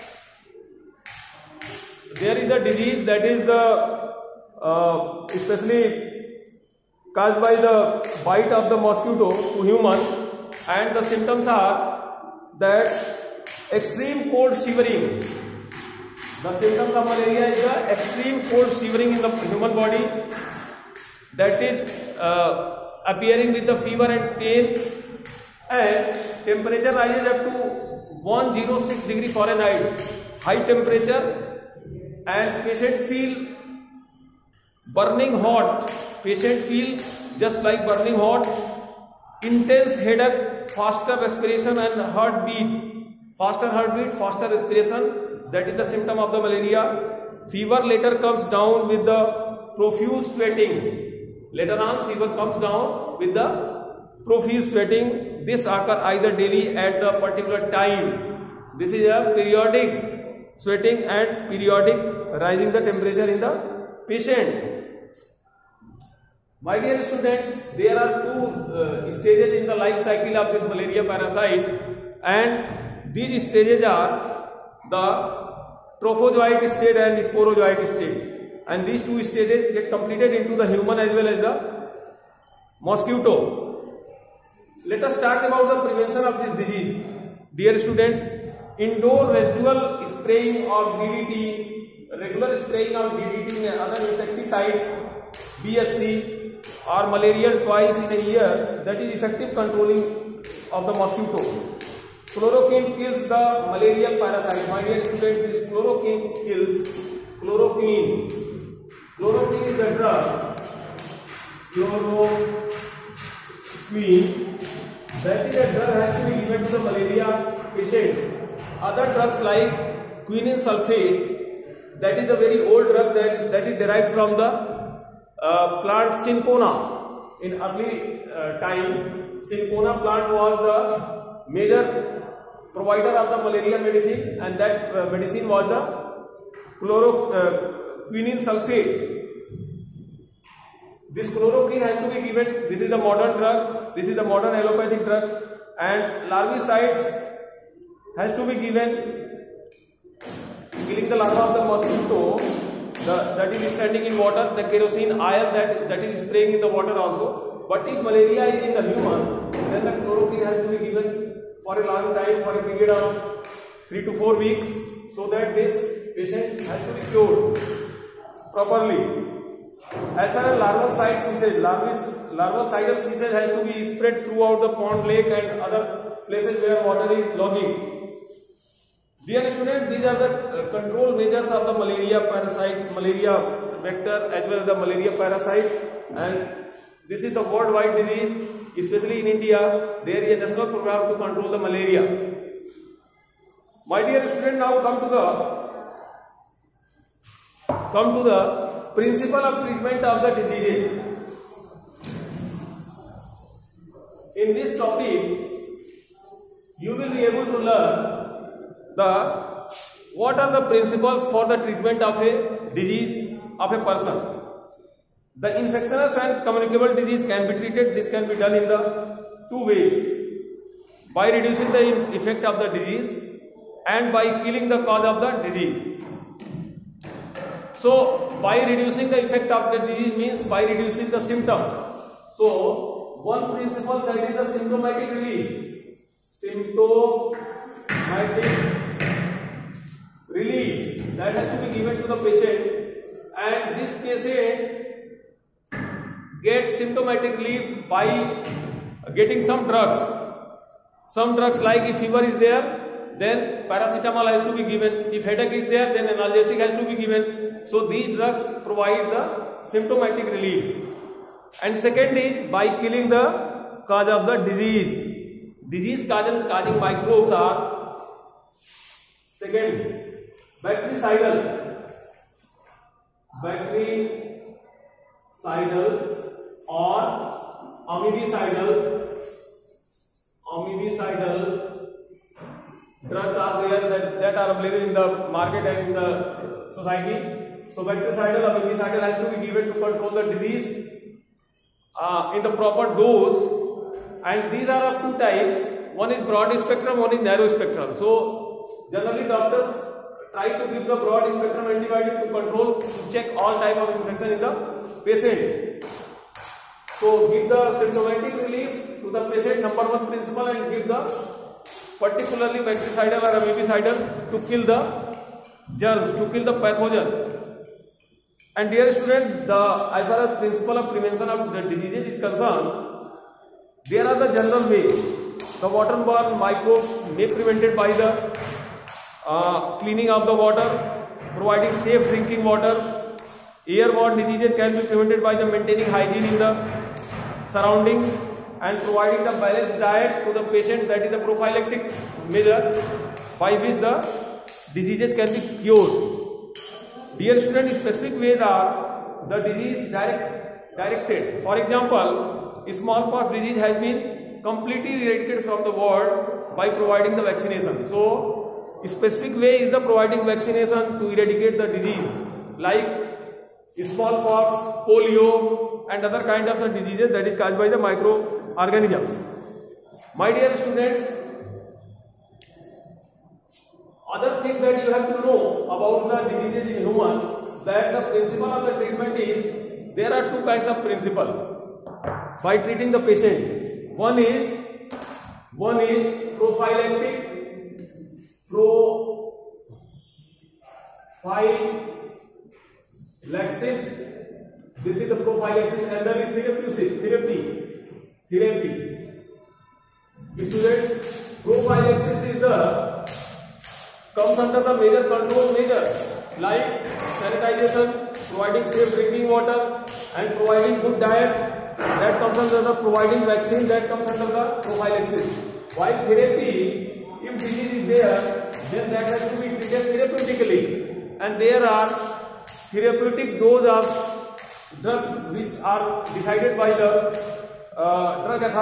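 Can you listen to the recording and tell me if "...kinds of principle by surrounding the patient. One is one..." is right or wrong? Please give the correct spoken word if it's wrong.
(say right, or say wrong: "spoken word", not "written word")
wrong: "treating", not "surrounding".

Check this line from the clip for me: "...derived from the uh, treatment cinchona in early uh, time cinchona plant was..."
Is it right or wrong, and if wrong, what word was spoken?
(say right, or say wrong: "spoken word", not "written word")
wrong: "plant", not "treatment".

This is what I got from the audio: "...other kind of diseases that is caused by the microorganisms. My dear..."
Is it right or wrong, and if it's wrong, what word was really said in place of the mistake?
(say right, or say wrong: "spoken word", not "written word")
right.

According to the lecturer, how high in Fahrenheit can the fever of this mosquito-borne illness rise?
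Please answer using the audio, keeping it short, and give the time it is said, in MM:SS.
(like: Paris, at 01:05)
106 degree Fahrenheit, at 00:28.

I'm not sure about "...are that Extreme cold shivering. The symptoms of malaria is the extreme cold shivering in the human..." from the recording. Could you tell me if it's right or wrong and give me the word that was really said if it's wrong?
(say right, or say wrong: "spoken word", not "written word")
right.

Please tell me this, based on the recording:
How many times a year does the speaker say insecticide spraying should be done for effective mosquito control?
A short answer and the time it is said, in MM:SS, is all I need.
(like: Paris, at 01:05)
twice in a year, at 01:37.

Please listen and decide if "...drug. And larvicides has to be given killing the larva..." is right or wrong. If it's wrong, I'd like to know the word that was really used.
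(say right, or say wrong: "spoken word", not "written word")
right.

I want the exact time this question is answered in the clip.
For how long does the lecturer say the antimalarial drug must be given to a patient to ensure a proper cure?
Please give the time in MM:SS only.
02:43.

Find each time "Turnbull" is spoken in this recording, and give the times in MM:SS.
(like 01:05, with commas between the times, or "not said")
not said.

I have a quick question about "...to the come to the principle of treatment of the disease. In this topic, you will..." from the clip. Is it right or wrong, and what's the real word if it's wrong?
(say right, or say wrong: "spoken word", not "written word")
right.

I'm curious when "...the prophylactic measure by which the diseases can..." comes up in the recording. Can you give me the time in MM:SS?
05:41.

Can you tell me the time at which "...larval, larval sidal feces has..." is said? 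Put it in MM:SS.
02:51.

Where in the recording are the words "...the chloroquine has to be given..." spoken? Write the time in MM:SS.
02:39.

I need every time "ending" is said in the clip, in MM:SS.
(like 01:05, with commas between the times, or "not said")
not said.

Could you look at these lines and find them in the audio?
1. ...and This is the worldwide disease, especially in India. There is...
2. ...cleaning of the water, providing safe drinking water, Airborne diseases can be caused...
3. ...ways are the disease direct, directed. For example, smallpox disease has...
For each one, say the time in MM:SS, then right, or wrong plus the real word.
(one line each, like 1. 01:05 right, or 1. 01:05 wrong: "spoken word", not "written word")
1. 03:06 right
2. 05:29 wrong: "prevented", not "caused"
3. 05:48 right.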